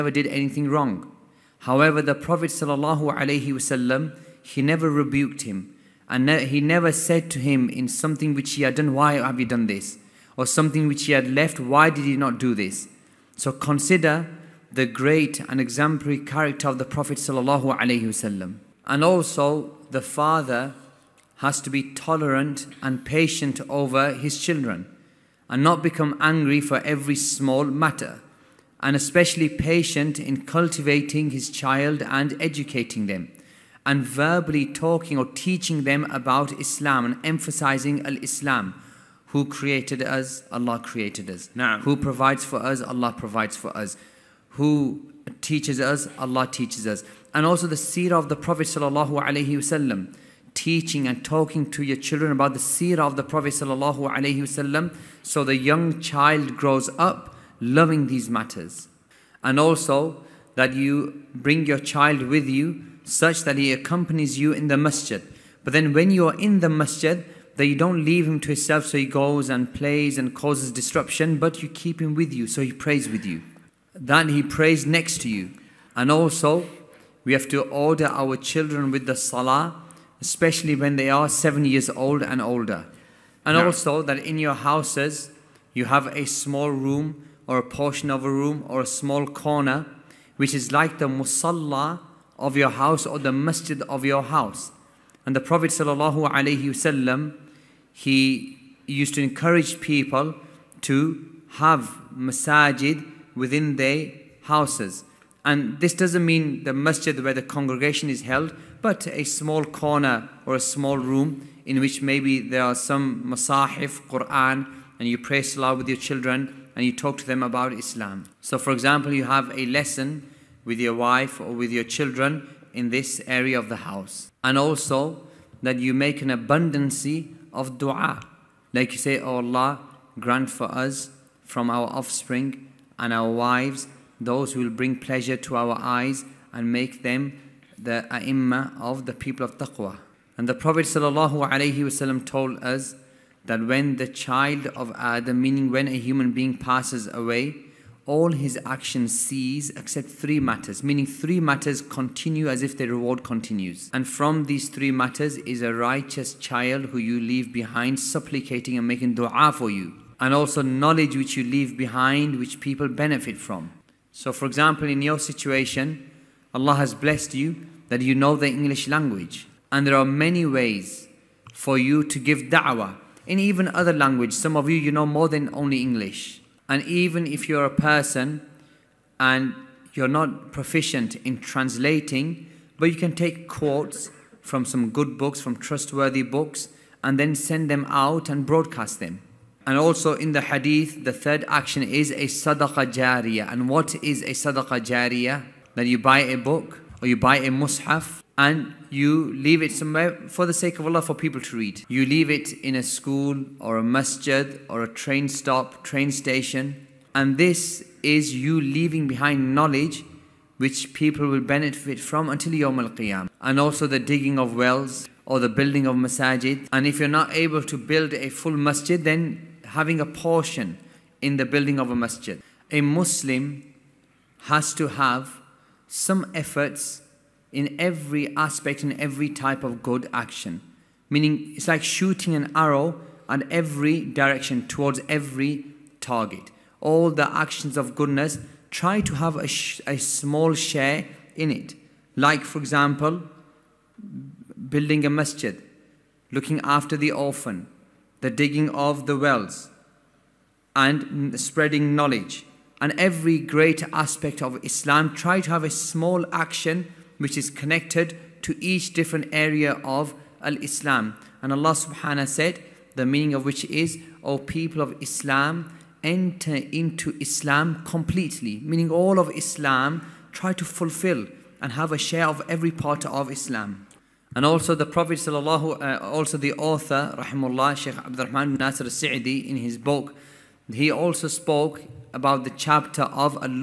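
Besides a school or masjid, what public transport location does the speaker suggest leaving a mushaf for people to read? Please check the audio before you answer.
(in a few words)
Train station.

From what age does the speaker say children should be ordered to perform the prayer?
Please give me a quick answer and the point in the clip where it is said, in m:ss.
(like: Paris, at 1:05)
7, at 1:21.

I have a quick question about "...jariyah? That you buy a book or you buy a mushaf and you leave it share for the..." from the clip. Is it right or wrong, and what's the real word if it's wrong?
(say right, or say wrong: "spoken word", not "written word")
wrong: "somewhere", not "share".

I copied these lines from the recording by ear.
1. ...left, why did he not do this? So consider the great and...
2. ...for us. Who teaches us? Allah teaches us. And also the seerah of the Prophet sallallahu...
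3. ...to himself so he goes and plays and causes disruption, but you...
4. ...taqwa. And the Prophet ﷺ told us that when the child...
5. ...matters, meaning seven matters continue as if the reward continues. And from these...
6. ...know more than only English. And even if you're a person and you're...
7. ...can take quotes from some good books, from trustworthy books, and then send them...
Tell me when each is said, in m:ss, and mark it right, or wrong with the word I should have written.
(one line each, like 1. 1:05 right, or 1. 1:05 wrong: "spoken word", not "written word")
1. 0:11 right
2. 0:43 right
3. 1:08 right
4. 2:19 right
5. 2:30 wrong: "three", not "seven"
6. 2:54 right
7. 3:02 right.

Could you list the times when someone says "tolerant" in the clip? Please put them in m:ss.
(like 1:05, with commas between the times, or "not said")
0:21.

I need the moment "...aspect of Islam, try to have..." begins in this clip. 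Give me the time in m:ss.
4:13.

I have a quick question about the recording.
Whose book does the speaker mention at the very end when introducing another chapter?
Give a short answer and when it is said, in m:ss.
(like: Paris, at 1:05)
Sheikh Rahman Nasir Sa'di, at 4:37.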